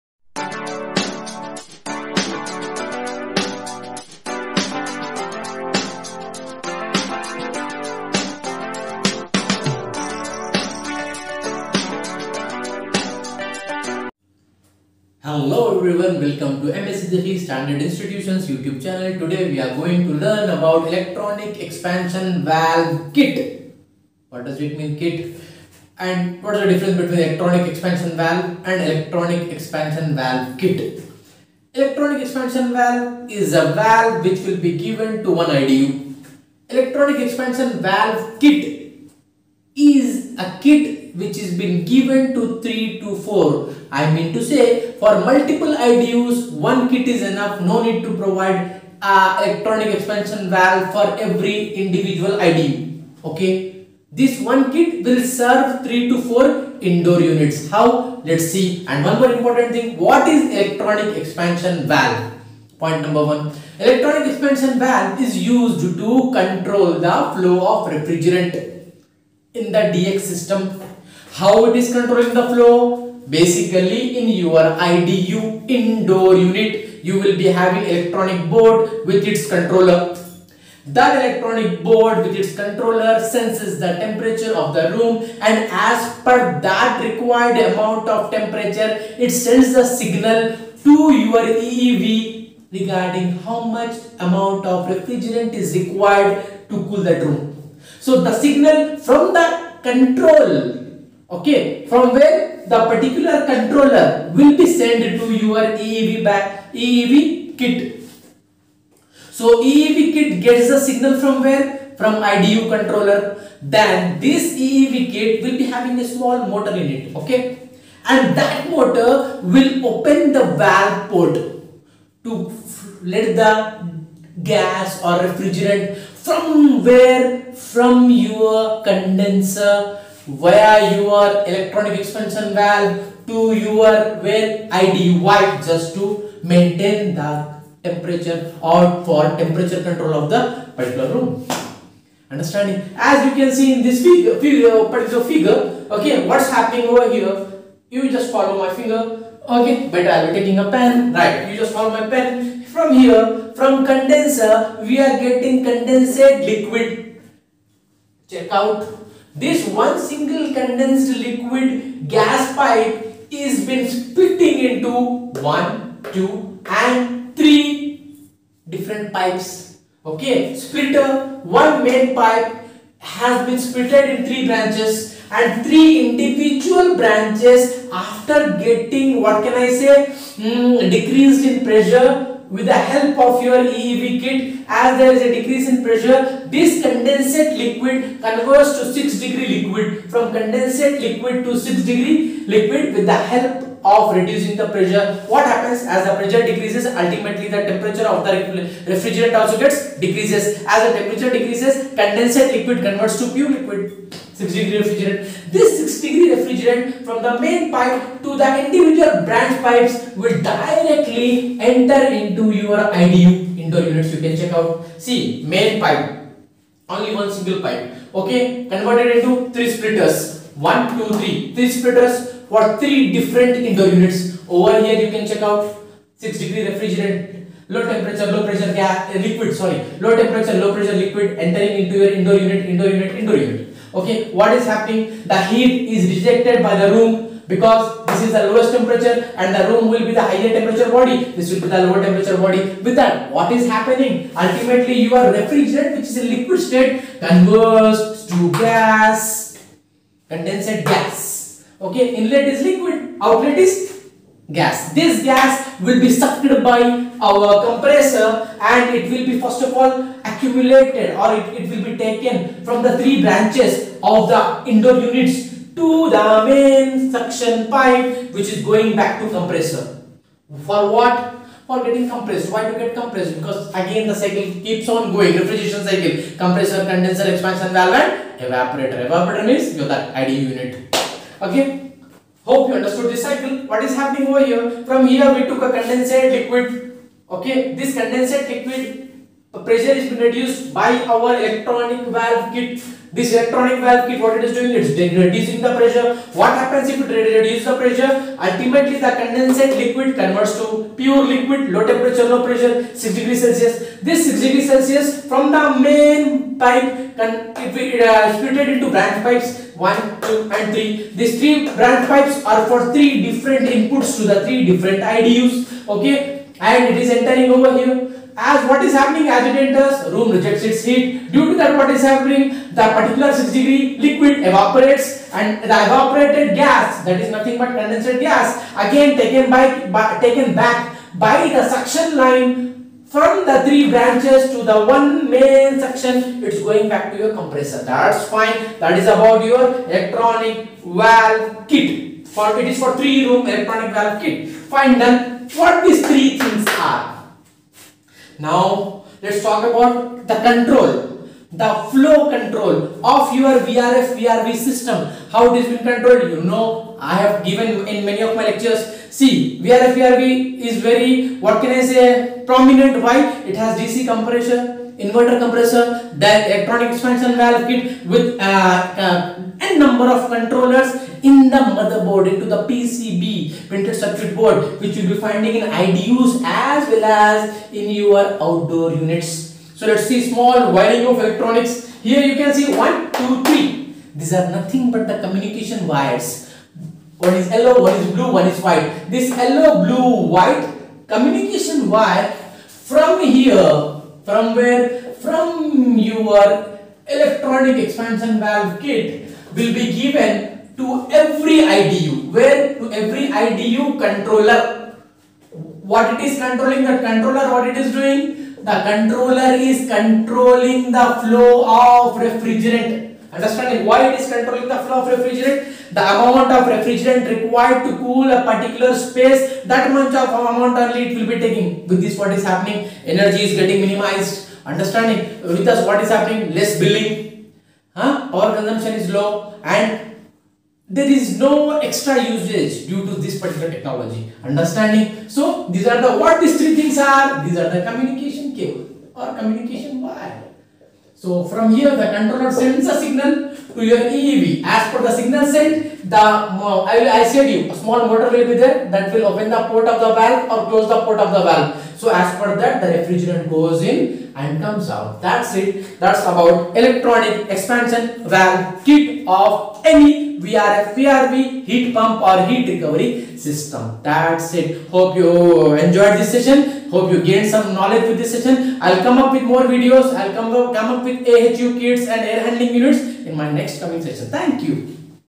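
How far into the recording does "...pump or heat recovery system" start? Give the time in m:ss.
7:41.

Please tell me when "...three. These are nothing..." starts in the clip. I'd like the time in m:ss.
6:23.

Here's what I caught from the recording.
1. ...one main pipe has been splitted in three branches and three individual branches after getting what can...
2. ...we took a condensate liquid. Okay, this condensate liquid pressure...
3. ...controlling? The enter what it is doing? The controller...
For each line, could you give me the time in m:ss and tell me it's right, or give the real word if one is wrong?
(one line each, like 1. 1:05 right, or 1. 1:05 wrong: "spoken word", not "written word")
1. 2:51 right
2. 4:45 right
3. 6:46 wrong: "controller", not "enter".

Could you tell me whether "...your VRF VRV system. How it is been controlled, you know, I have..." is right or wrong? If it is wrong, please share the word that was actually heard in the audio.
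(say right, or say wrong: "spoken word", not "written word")
right.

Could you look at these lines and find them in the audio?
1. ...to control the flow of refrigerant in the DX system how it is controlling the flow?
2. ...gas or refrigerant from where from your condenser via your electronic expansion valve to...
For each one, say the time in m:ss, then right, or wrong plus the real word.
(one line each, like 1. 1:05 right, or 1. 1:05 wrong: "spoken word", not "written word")
1. 1:06 right
2. 2:04 right.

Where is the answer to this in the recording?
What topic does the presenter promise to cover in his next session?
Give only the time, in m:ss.
7:51.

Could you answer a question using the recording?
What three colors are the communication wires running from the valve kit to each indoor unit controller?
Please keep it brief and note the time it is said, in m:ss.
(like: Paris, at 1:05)
Yellow, blue, white, at 6:29.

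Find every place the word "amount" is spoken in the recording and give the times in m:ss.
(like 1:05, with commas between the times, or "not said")
1:27, 1:34, 6:56, 7:00.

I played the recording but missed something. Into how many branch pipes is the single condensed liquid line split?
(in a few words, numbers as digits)
3.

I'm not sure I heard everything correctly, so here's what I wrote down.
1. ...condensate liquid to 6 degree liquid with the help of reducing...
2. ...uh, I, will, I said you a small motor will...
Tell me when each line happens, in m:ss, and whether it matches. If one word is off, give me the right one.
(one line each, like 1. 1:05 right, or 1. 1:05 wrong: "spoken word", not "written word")
1. 3:10 right
2. 7:26 right.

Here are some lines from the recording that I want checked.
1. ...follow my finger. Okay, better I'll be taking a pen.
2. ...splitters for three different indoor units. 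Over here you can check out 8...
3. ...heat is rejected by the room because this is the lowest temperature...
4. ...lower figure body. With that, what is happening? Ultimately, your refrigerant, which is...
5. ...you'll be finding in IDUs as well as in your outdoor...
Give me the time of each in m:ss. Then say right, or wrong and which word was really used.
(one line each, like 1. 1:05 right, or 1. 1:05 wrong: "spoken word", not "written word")
1. 2:28 right
2. 3:41 wrong: "6", not "8"
3. 3:55 right
4. 4:01 wrong: "temperature", not "figure"
5. 6:14 right.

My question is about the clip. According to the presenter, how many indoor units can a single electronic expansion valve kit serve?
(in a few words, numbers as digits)
3 to 4.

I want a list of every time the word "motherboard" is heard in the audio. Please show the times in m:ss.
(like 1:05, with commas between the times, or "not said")
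6:11.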